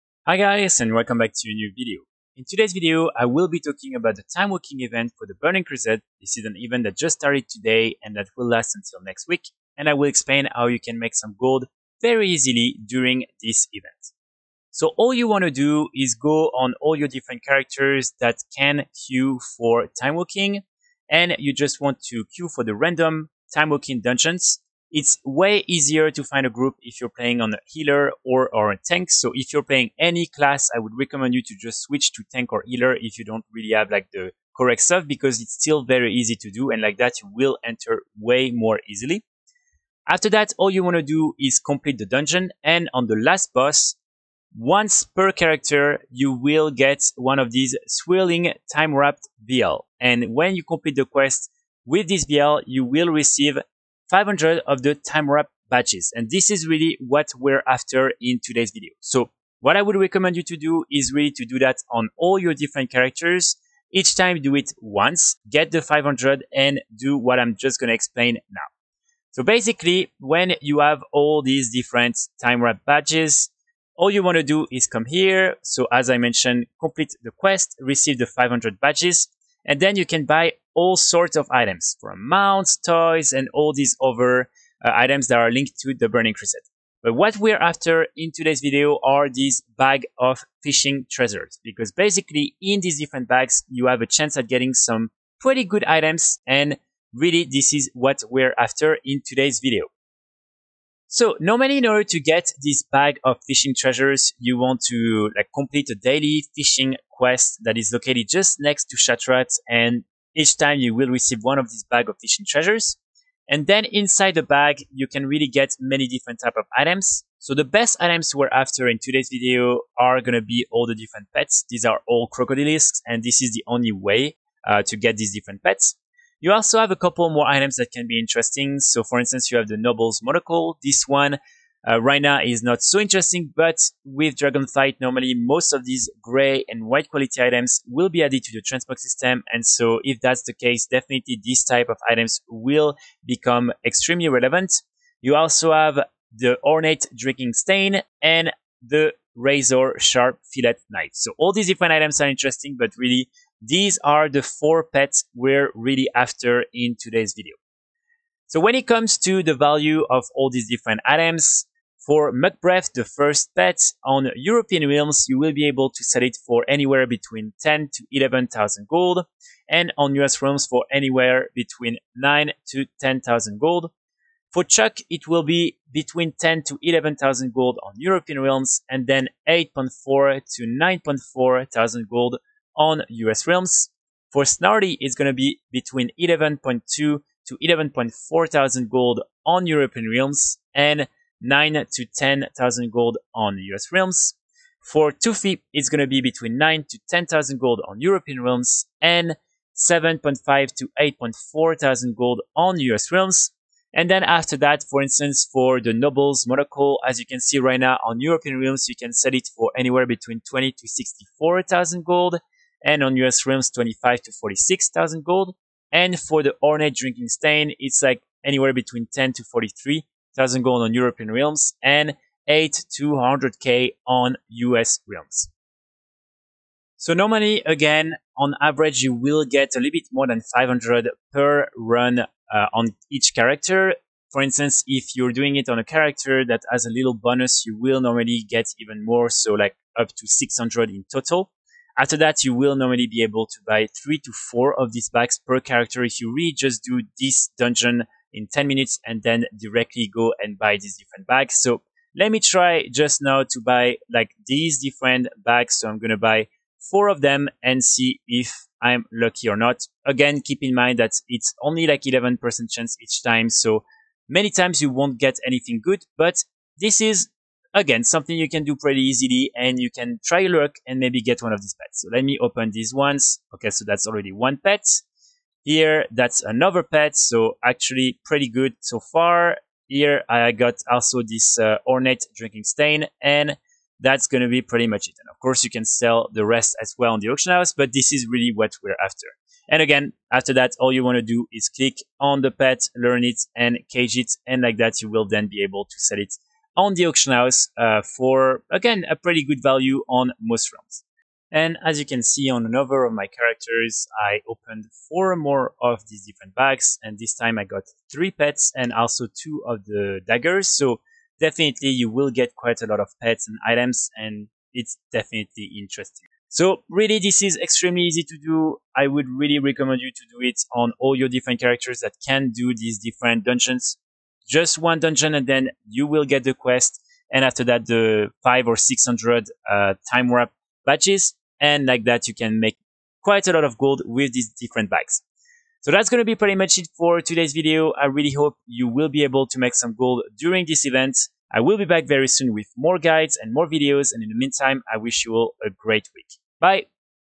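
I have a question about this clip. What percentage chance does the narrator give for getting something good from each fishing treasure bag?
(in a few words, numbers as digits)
11%.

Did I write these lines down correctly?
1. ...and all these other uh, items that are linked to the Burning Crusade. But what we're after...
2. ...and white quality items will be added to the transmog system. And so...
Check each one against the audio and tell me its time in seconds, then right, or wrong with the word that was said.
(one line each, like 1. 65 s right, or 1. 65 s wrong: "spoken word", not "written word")
1. 83 s right
2. 136 s right.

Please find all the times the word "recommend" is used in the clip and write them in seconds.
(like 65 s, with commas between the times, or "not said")
30 s, 59 s, 319 s.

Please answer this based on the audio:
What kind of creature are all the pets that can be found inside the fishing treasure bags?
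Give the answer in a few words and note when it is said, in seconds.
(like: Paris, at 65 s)
crocodilisks, at 122 s.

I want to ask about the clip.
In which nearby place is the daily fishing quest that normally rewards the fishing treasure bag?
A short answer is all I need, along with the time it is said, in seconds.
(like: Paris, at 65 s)
Shattrath, at 108 s.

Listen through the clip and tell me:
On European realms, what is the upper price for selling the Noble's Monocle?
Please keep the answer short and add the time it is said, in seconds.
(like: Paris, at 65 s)
64,000 gold, at 210 s.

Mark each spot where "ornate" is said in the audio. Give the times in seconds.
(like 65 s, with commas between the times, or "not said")
146 s, 216 s, 281 s.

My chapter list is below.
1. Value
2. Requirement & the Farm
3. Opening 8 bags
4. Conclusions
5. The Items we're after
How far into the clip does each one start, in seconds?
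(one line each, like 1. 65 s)
1. 158 s
2. 15 s
3. 226 s
4. 316 s
5. 100 s.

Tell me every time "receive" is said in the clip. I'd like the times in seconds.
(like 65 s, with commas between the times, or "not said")
53 s, 77 s, 111 s.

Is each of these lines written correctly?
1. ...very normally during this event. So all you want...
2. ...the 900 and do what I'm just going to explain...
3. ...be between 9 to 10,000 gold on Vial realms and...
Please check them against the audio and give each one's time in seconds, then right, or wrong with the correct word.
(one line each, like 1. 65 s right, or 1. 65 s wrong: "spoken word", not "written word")
1. 12 s wrong: "easily", not "normally"
2. 65 s wrong: "500", not "900"
3. 196 s wrong: "European", not "Vial".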